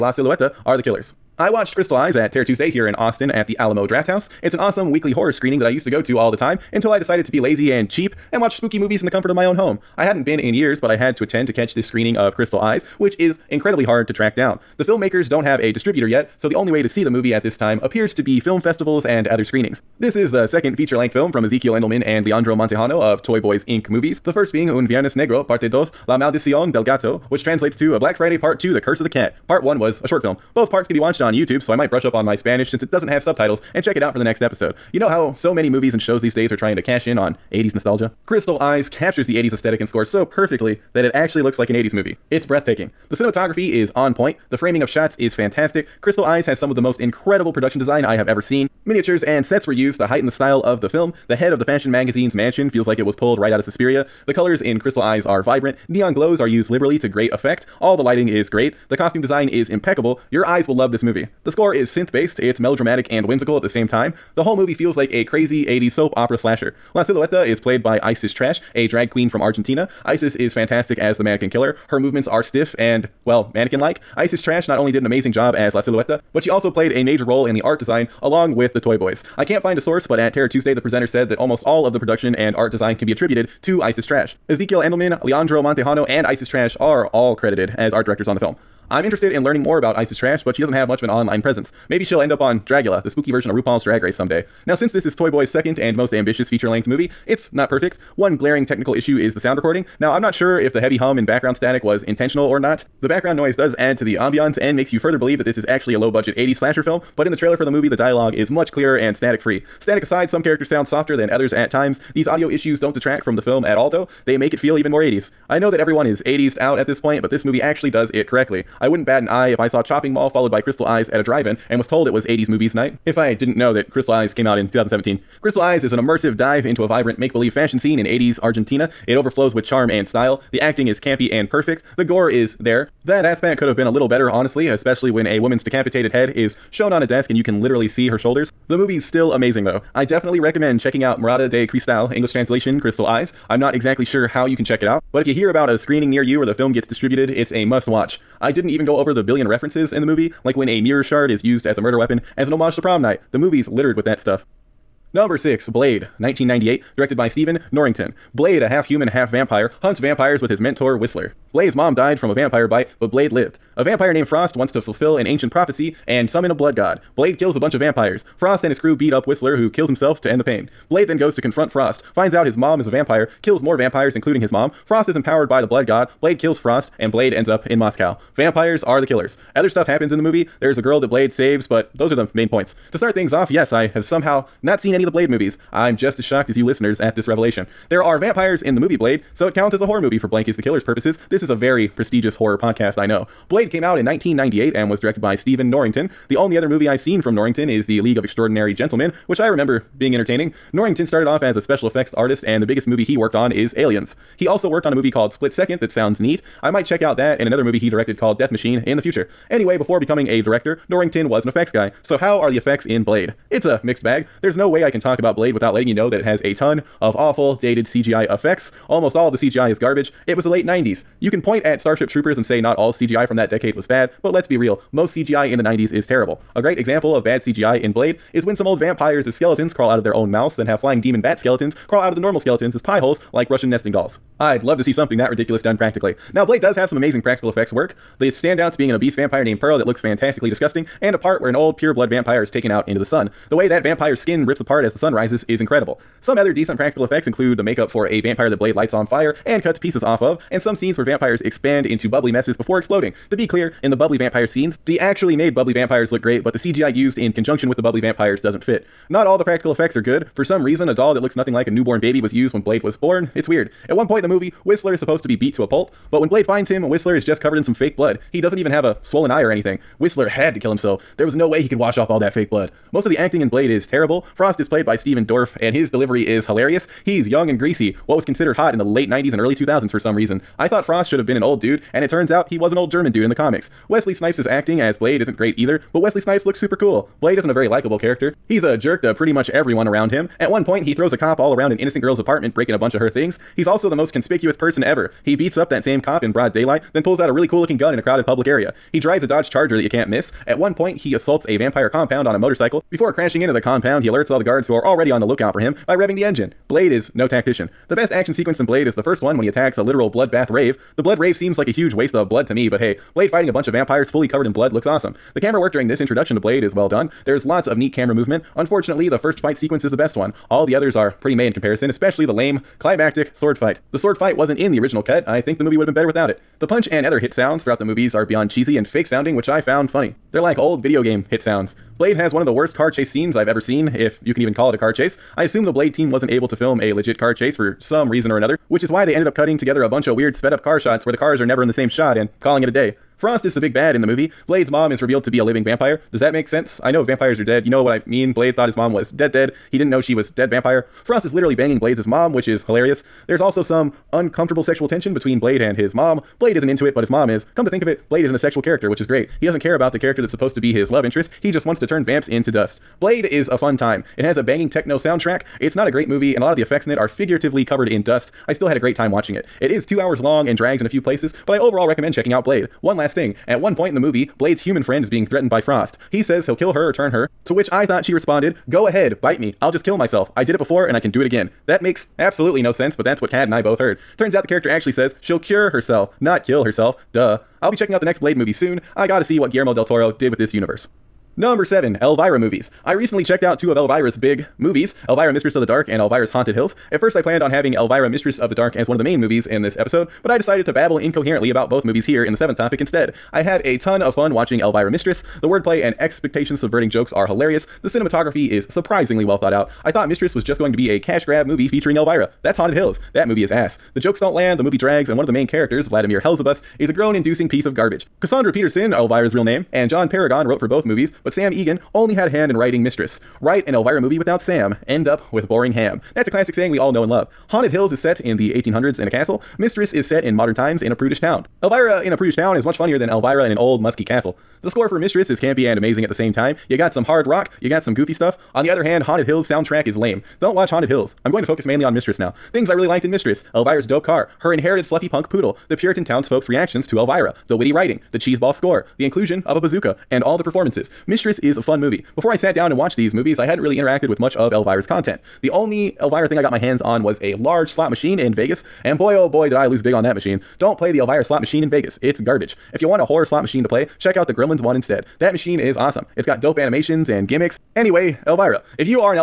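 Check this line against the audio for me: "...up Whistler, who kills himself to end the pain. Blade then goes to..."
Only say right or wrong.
right.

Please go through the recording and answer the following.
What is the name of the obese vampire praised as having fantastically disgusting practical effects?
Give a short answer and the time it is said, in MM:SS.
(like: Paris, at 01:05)
Pearl, at 03:59.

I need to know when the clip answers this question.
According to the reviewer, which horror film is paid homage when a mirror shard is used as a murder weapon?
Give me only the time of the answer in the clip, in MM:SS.
02:32.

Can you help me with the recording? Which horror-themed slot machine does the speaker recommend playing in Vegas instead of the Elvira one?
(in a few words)
Gremlins.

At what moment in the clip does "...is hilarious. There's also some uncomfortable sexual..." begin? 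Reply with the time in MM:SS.
05:52.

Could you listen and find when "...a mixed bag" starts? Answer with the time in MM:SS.
03:33.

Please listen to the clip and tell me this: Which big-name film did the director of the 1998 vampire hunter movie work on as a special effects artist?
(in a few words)
Aliens.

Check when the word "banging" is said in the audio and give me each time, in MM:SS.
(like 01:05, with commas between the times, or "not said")
05:51, 06:04.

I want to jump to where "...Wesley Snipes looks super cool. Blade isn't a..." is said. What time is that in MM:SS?
04:45.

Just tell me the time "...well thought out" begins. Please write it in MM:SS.
06:49.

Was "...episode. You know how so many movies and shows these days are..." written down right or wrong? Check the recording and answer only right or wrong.
right.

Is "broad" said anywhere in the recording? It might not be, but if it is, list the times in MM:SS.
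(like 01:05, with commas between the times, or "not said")
04:56.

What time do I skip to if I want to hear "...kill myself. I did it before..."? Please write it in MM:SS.
06:19.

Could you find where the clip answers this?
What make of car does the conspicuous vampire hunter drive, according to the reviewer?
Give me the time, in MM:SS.
04:59.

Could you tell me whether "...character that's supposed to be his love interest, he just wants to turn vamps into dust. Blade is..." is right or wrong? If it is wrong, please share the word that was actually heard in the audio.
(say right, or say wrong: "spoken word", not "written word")
right.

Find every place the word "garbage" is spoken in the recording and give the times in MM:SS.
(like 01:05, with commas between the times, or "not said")
03:39, 06:57, 07:42.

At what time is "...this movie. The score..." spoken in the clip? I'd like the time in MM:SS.
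01:00.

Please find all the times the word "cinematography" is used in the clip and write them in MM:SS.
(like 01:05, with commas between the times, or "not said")
00:43, 06:47.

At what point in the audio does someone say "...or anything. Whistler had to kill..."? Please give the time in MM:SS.
04:29.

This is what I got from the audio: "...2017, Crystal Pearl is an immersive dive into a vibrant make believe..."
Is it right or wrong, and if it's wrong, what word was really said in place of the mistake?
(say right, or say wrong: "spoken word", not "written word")
wrong: "Eyes", not "Pearl".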